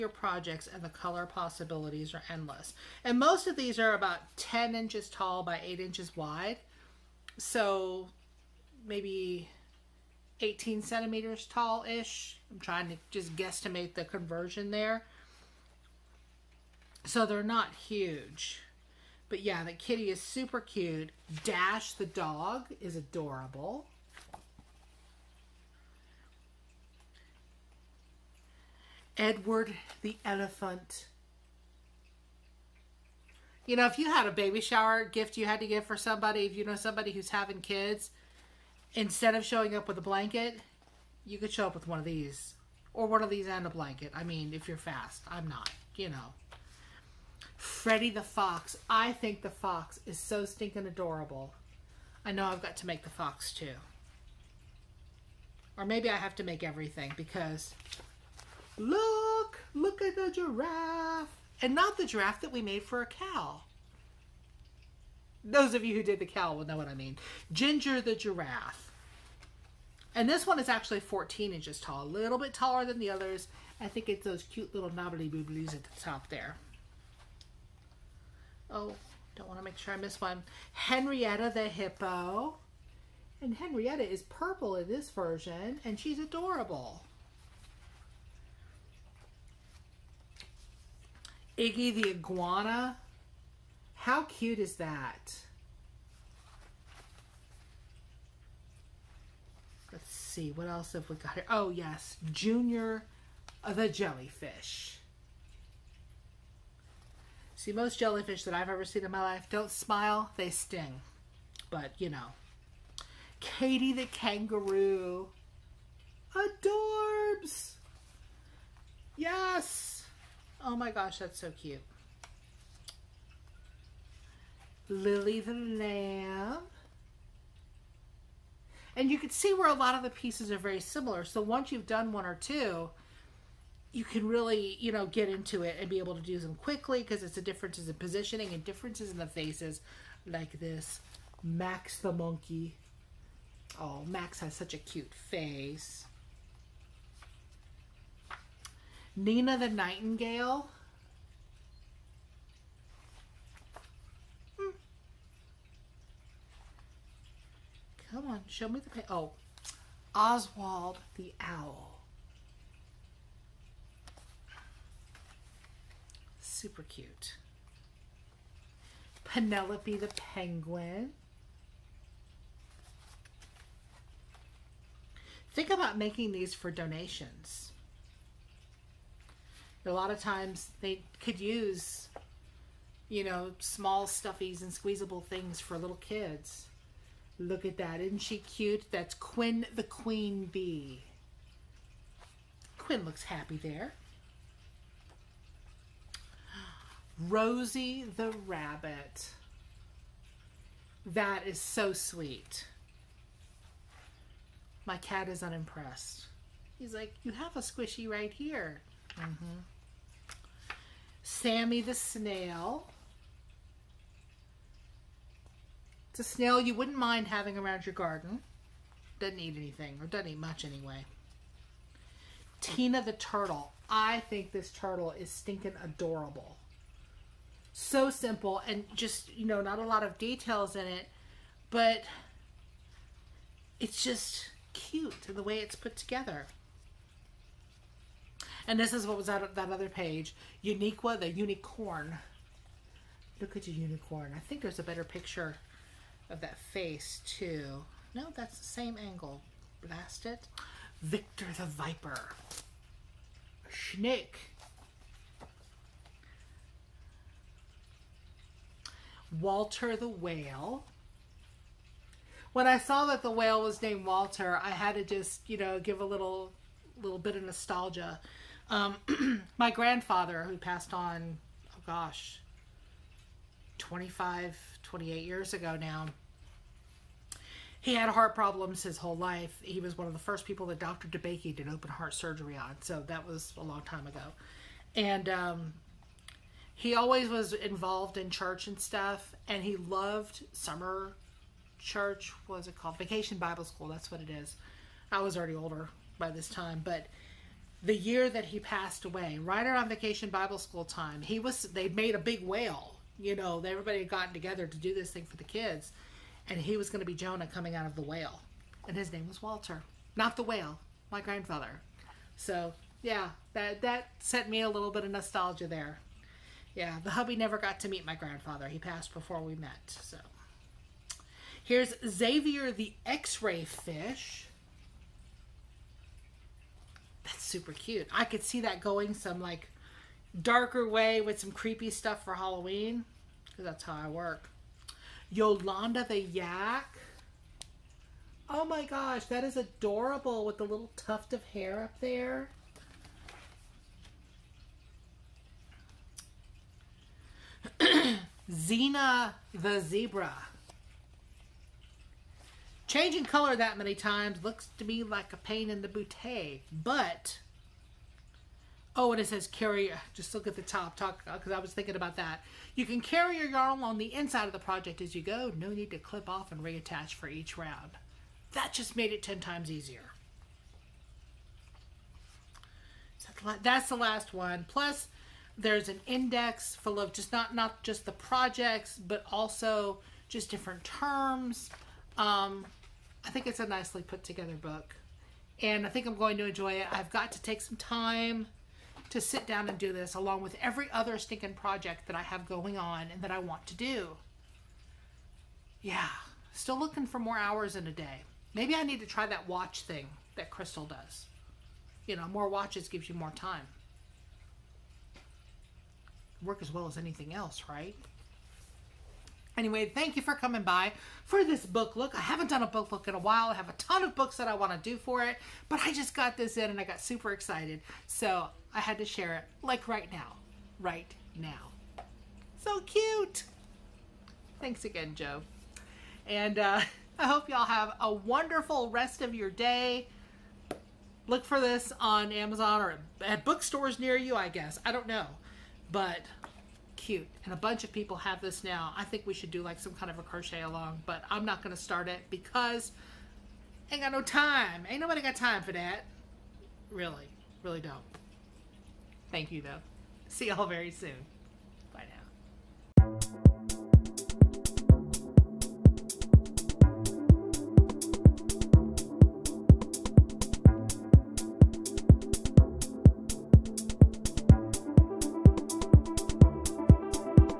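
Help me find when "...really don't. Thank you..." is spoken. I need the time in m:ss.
7:27.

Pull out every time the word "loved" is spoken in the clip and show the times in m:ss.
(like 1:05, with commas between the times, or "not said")
4:49.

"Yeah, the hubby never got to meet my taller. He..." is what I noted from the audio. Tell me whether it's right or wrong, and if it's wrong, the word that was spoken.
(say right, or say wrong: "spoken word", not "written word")
wrong: "grandfather", not "taller".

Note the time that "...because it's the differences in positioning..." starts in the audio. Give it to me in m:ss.
2:17.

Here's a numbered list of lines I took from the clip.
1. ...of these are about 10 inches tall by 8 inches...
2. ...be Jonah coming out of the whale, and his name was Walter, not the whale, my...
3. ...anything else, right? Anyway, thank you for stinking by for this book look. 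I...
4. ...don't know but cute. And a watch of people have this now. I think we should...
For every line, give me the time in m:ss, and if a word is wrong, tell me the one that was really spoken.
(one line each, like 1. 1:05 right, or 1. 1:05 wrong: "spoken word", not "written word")
1. 0:03 right
2. 5:07 right
3. 6:46 wrong: "coming", not "stinking"
4. 7:14 wrong: "bunch", not "watch".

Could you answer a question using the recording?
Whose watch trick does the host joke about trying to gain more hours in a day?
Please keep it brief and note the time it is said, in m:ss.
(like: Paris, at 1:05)
Crystal, at 6:40.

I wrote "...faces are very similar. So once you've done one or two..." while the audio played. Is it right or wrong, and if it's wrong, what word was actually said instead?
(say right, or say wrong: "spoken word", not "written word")
wrong: "pieces", not "faces".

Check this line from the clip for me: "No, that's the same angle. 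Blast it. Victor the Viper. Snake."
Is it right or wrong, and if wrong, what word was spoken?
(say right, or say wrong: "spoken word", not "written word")
right.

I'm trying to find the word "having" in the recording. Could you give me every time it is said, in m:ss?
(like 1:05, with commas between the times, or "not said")
0:37, 3:37.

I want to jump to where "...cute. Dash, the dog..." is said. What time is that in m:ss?
0:20.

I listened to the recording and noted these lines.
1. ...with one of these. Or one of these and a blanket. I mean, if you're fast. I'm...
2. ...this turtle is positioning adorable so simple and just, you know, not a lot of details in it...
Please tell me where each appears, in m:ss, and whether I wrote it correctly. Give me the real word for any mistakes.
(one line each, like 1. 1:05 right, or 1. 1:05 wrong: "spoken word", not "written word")
1. 0:41 right
2. 3:44 wrong: "stinking", not "positioning".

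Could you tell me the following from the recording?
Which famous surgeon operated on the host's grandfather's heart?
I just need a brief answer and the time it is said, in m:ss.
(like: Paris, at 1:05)
Dr. DeBakey, at 4:40.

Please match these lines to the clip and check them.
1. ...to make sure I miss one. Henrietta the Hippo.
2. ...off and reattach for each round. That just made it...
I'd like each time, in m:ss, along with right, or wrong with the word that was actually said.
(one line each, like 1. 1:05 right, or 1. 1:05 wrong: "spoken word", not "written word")
1. 1:19 right
2. 6:06 right.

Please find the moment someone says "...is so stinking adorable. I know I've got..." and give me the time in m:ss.
0:50.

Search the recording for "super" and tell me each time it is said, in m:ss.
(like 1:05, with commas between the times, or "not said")
0:20, 2:46, 5:27, 6:56.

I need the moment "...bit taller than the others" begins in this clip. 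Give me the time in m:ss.
1:12.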